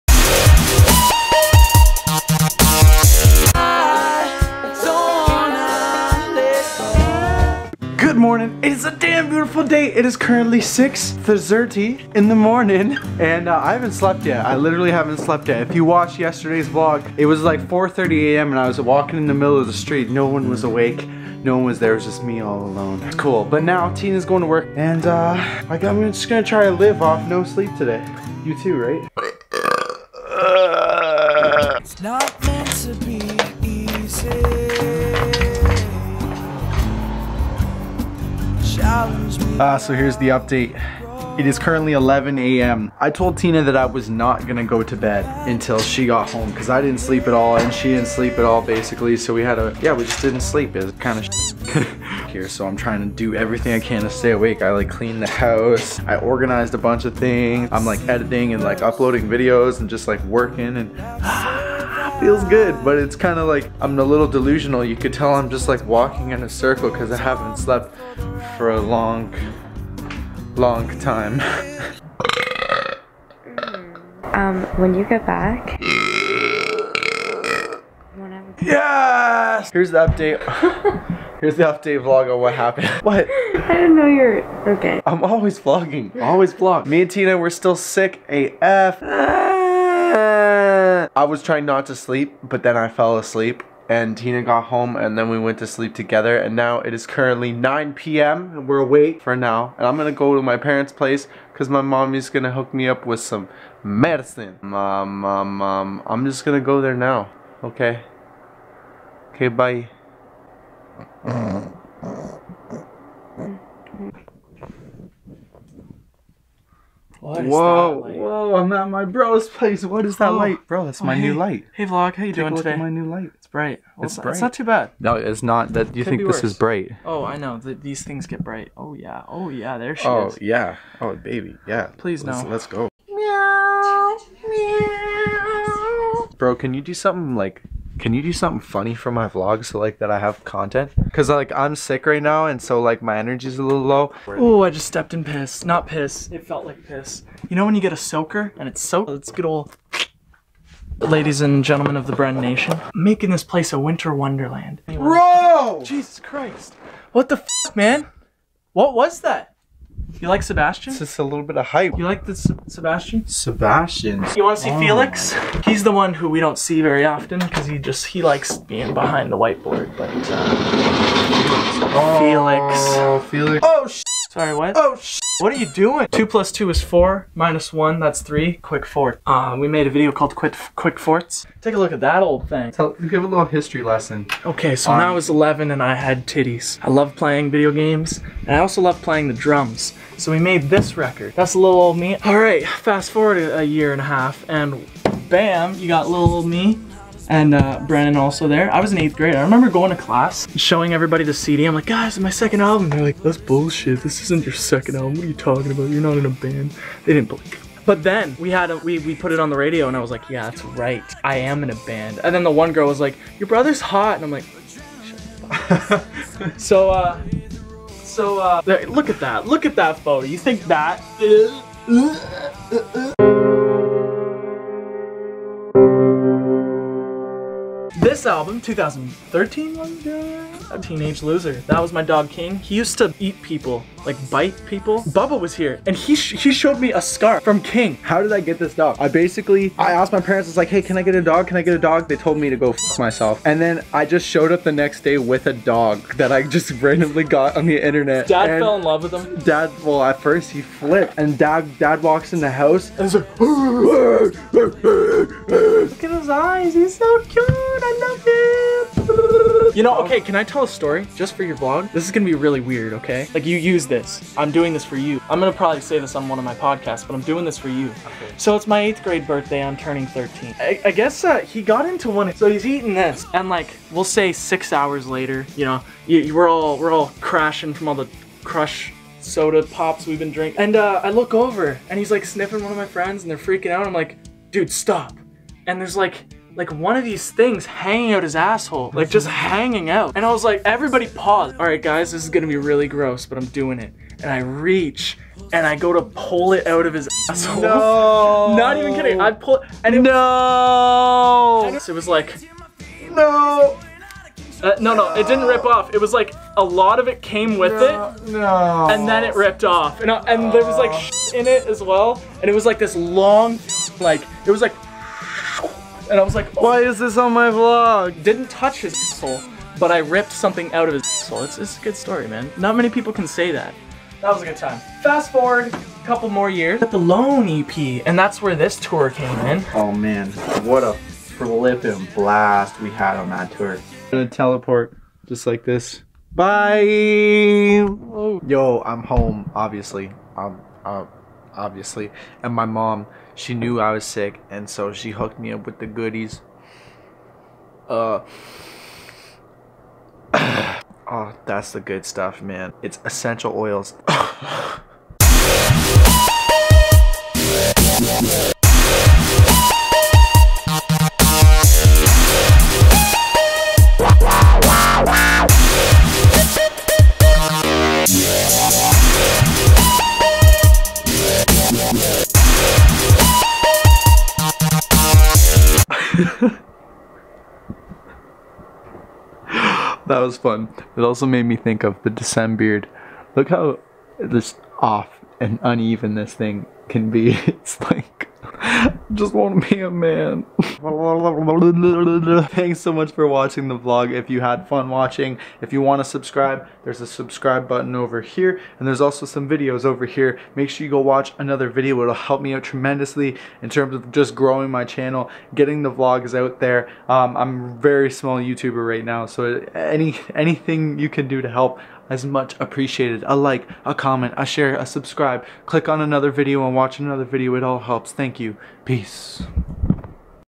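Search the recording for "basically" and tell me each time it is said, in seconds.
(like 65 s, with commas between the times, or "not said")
48 s, 239 s.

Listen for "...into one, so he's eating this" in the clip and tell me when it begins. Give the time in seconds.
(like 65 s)
271 s.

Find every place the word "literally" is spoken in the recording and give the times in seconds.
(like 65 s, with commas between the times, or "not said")
14 s.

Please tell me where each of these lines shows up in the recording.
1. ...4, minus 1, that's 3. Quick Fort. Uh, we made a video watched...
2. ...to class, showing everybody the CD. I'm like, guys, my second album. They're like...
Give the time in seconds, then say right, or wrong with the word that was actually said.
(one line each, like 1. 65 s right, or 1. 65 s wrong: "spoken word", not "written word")
1. 176 s wrong: "called", not "watched"
2. 199 s right.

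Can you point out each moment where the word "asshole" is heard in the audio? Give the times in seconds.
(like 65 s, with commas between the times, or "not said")
288 s, 297 s.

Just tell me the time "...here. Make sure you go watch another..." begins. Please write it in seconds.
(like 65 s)
400 s.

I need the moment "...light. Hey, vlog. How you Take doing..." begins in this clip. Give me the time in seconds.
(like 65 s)
121 s.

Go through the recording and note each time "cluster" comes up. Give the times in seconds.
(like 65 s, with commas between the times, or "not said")
not said.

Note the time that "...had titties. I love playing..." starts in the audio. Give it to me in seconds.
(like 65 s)
185 s.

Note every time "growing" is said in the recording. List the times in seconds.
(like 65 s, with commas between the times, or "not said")
404 s.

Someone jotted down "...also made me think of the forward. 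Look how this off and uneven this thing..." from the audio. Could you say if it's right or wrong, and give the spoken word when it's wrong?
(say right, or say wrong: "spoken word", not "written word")
wrong: "beard", not "forward".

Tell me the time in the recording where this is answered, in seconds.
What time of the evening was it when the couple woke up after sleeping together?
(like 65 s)
97 s.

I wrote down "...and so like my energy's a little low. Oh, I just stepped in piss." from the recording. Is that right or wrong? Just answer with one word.
right.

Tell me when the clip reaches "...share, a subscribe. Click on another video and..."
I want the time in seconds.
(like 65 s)
414 s.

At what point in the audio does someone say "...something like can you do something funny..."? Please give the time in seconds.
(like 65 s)
136 s.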